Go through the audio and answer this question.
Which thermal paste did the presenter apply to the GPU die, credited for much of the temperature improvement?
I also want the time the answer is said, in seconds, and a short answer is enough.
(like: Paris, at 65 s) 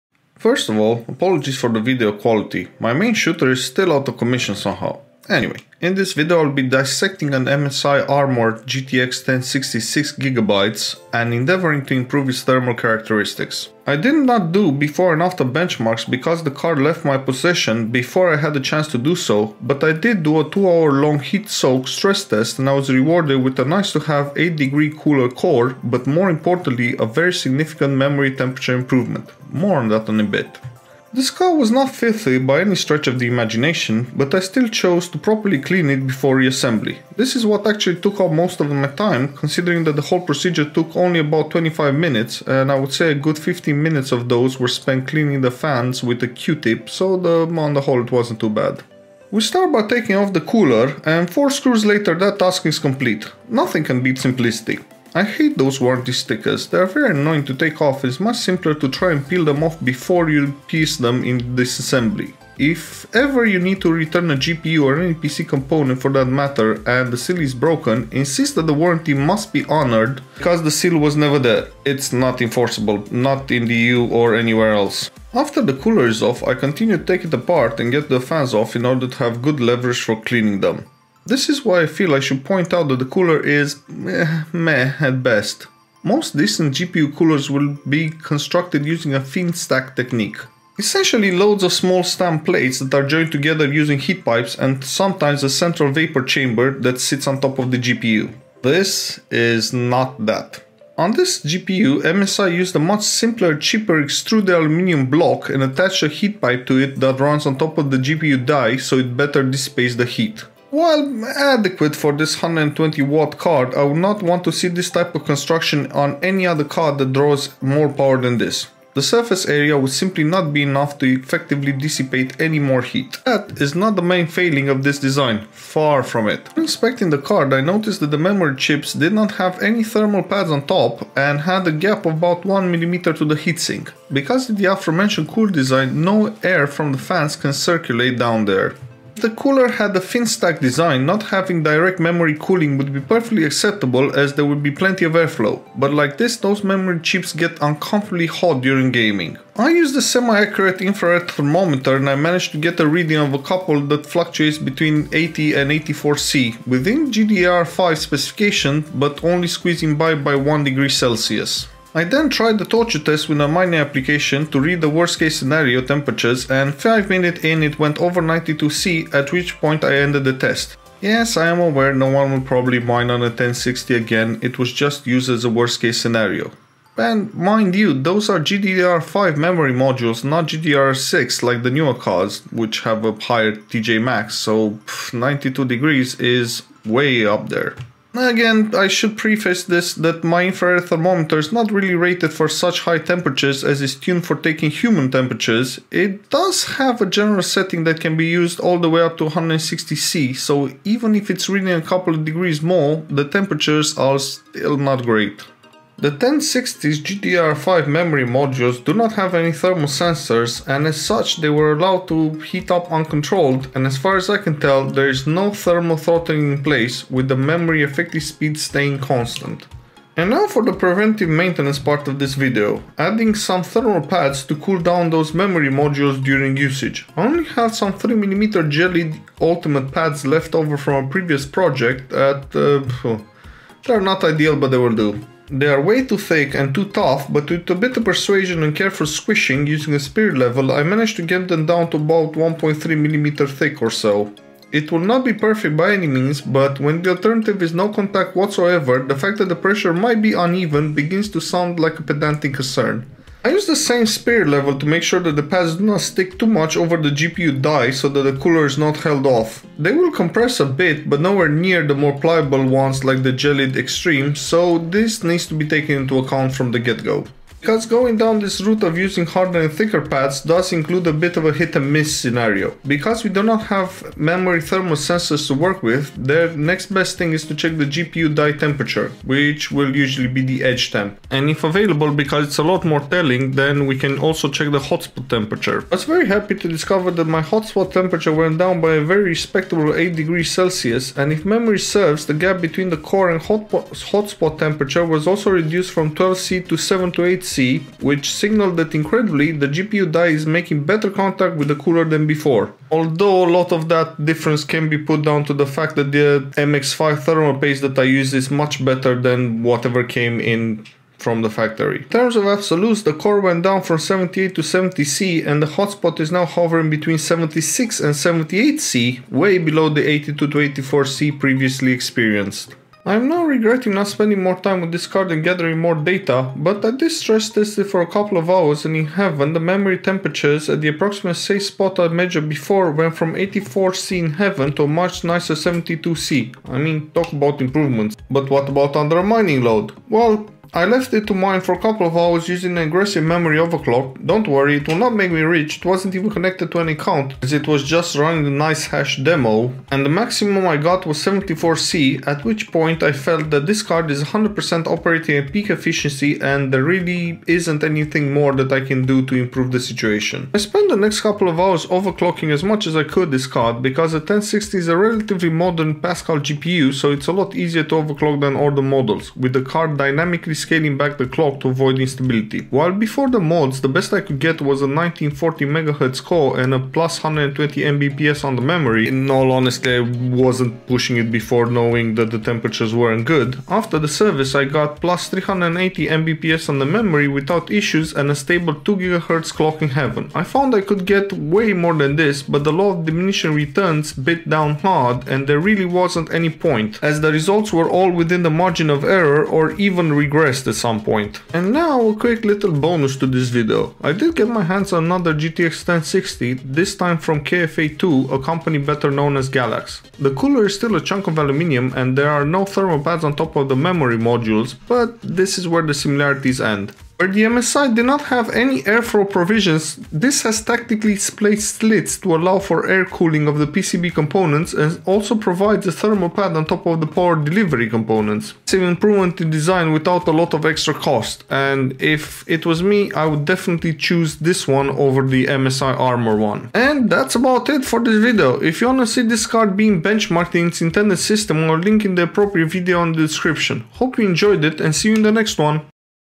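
MX5, at 306 s.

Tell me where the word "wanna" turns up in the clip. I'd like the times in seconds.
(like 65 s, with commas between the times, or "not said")
438 s.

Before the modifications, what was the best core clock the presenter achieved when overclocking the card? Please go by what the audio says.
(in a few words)
1940 MHz.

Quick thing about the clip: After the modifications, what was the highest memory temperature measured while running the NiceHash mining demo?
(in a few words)
74C.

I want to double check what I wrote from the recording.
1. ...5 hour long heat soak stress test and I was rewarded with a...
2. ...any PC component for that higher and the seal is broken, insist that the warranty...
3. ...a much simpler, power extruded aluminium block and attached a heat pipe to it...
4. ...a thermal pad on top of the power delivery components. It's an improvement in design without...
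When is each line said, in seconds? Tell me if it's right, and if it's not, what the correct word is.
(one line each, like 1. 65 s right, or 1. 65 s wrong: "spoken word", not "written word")
1. 20 s wrong: "2", not "5"
2. 65 s wrong: "matter", not "higher"
3. 102 s wrong: "cheaper", not "power"
4. 425 s right.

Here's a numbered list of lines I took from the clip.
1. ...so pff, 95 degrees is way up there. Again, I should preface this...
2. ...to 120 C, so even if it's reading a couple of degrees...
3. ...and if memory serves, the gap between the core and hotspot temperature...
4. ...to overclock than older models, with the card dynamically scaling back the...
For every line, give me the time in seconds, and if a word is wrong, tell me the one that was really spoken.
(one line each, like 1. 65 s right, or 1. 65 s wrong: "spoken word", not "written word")
1. 184 s wrong: "92", not "95"
2. 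199 s wrong: "160", not "120"
3. 291 s right
4. 367 s right.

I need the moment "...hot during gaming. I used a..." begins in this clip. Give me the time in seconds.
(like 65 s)
148 s.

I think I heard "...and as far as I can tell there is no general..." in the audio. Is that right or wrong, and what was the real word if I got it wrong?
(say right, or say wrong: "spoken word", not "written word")
wrong: "thermal", not "general".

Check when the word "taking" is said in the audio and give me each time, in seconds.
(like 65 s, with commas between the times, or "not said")
49 s, 194 s.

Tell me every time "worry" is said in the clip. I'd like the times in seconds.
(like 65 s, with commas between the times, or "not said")
344 s.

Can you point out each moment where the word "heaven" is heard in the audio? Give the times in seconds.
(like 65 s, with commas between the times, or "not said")
329 s, 334 s, 389 s.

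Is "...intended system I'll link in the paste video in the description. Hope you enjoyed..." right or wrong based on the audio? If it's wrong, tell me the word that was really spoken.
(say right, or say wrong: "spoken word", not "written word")
wrong: "appropriate", not "paste".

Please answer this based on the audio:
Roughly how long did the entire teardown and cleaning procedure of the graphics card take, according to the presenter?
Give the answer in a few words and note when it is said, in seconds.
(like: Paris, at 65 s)
25 minutes, at 41 s.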